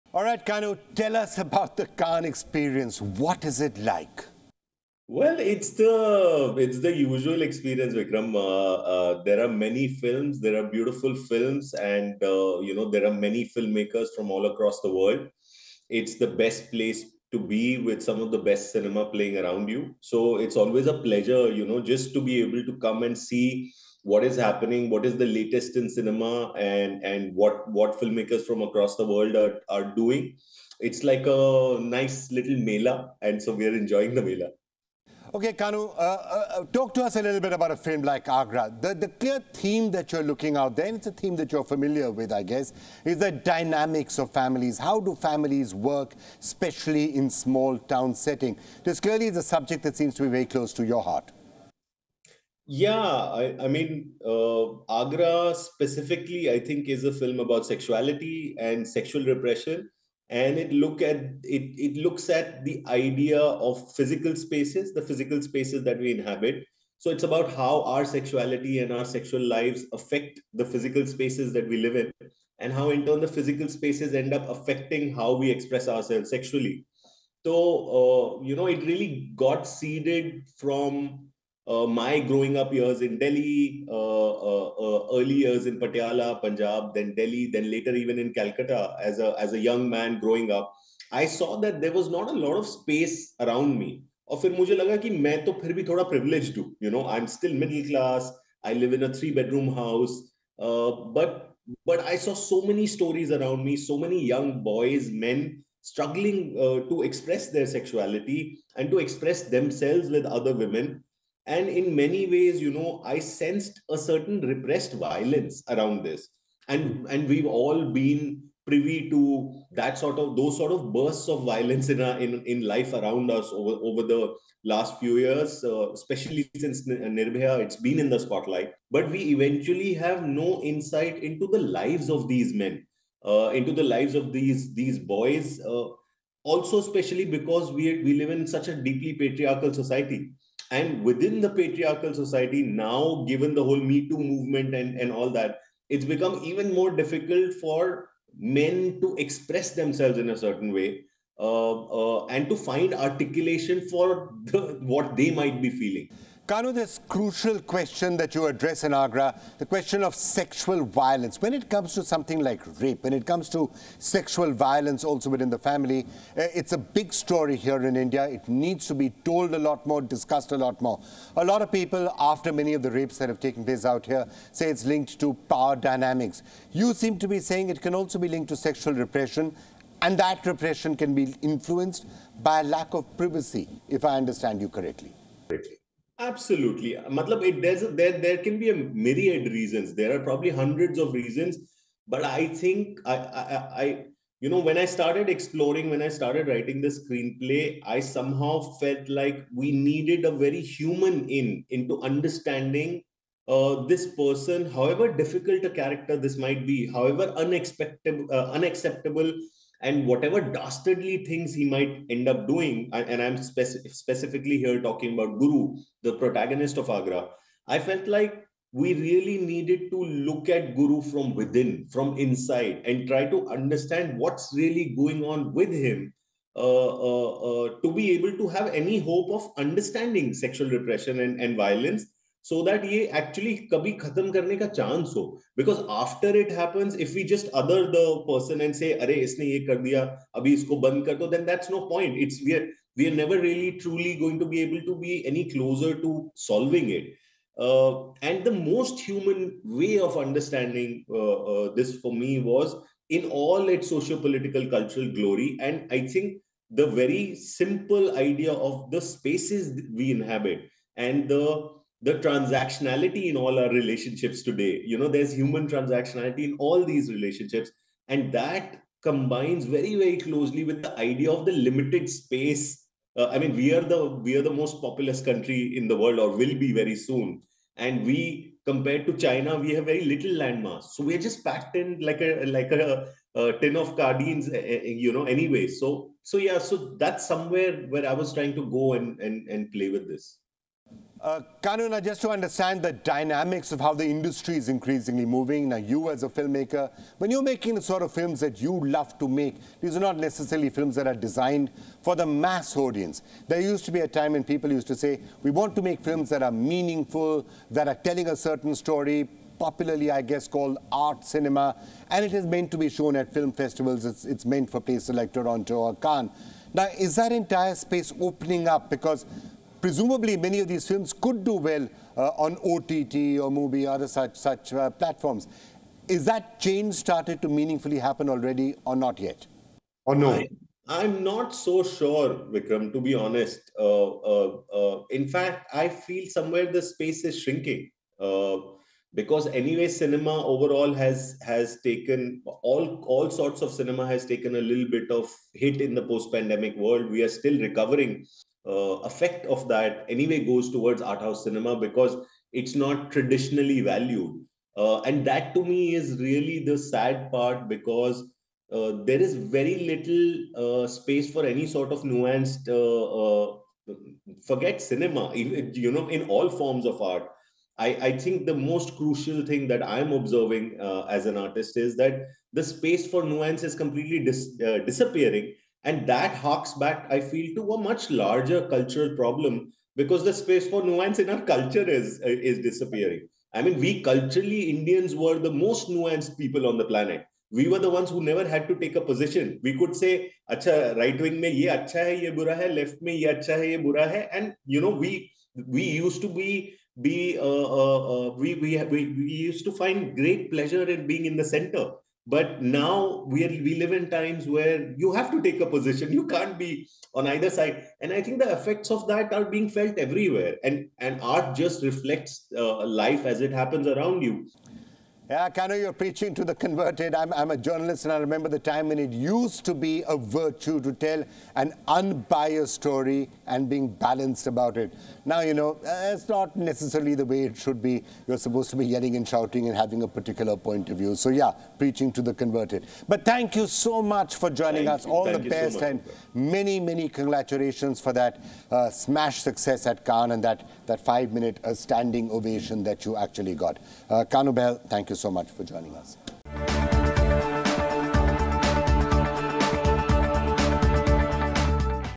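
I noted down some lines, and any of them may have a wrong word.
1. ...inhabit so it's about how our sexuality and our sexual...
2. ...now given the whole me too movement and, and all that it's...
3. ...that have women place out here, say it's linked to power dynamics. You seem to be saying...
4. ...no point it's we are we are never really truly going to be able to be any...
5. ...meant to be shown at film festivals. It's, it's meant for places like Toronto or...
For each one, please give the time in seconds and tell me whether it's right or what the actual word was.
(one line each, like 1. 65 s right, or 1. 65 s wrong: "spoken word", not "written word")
1. 66 s right
2. 142 s right
3. 173 s wrong: "taken", not "women"
4. 241 s right
5. 312 s right.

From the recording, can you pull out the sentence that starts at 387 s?
We were the ones who never had to take a position.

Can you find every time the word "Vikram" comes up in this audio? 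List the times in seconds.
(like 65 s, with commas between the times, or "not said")
7 s, 332 s.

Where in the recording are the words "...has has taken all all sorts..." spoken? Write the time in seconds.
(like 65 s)
340 s.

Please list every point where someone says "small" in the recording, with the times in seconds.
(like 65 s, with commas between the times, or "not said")
47 s.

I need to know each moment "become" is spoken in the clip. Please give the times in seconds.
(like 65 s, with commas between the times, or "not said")
146 s.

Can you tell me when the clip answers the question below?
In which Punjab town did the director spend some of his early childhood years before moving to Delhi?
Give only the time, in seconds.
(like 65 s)
85 s.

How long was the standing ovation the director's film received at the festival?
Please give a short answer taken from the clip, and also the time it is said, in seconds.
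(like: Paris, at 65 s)
5 minutes, at 441 s.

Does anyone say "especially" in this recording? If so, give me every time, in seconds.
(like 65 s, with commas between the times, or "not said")
46 s, 125 s, 136 s.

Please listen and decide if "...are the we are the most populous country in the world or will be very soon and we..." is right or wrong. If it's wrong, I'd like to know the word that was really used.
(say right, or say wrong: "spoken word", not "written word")
right.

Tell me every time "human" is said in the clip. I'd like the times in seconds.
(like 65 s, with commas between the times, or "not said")
200 s, 248 s, 265 s.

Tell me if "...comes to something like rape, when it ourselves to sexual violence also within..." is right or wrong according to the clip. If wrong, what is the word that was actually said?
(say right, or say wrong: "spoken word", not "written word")
wrong: "comes", not "ourselves".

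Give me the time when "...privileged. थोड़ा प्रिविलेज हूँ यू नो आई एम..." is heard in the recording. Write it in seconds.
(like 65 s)
95 s.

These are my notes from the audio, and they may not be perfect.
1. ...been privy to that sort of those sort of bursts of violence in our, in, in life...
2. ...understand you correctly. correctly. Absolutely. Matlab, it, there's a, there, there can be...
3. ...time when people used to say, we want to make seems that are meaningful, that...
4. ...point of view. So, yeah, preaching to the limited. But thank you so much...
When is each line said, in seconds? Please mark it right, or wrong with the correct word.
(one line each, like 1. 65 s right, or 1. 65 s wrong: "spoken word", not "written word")
1. 117 s right
2. 184 s right
3. 304 s wrong: "films", not "seems"
4. 430 s wrong: "converted", not "limited".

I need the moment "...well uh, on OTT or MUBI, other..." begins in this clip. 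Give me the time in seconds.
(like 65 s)
321 s.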